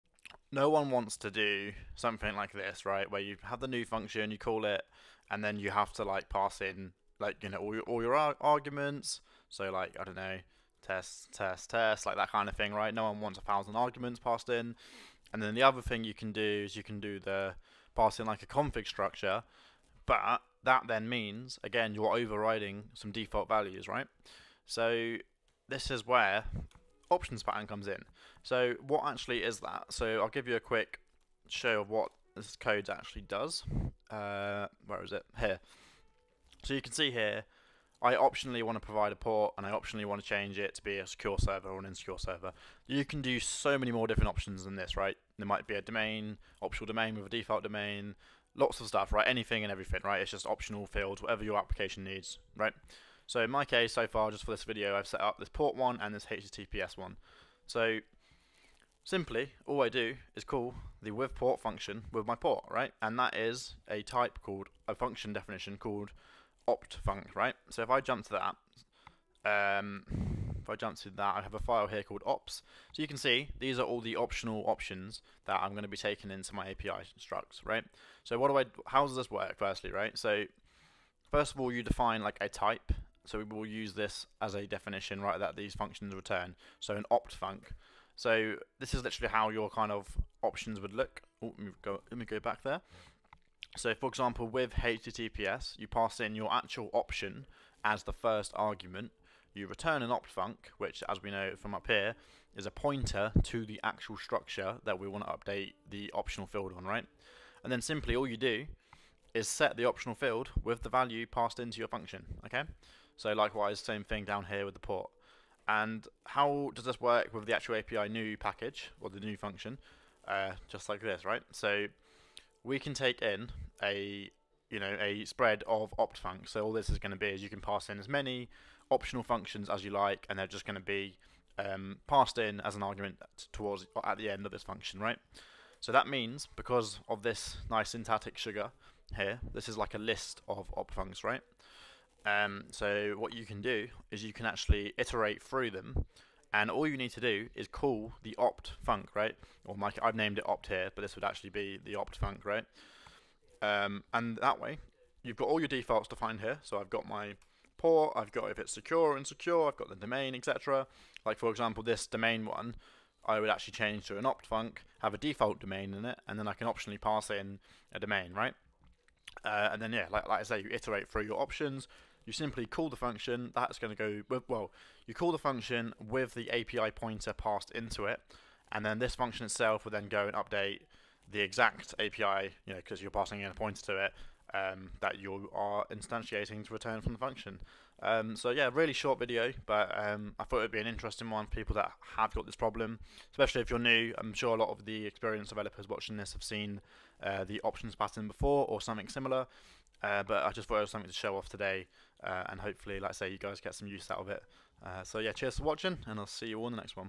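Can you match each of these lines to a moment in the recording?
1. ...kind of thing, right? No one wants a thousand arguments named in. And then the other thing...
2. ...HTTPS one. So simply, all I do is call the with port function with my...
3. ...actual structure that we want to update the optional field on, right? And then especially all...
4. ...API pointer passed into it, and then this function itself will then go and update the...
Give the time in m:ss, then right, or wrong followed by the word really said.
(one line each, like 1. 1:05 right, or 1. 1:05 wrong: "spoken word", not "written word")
1. 0:12 wrong: "passed", not "named"
2. 0:56 right
3. 1:43 wrong: "simply", not "especially"
4. 2:56 right.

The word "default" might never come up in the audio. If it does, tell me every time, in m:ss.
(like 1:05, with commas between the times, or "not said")
0:23, 0:47, 2:35, 2:45.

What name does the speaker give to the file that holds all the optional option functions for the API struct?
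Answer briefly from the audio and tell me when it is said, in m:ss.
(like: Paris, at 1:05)
ops, at 1:12.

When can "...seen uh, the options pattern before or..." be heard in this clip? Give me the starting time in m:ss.
3:16.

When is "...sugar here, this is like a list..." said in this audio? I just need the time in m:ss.
2:18.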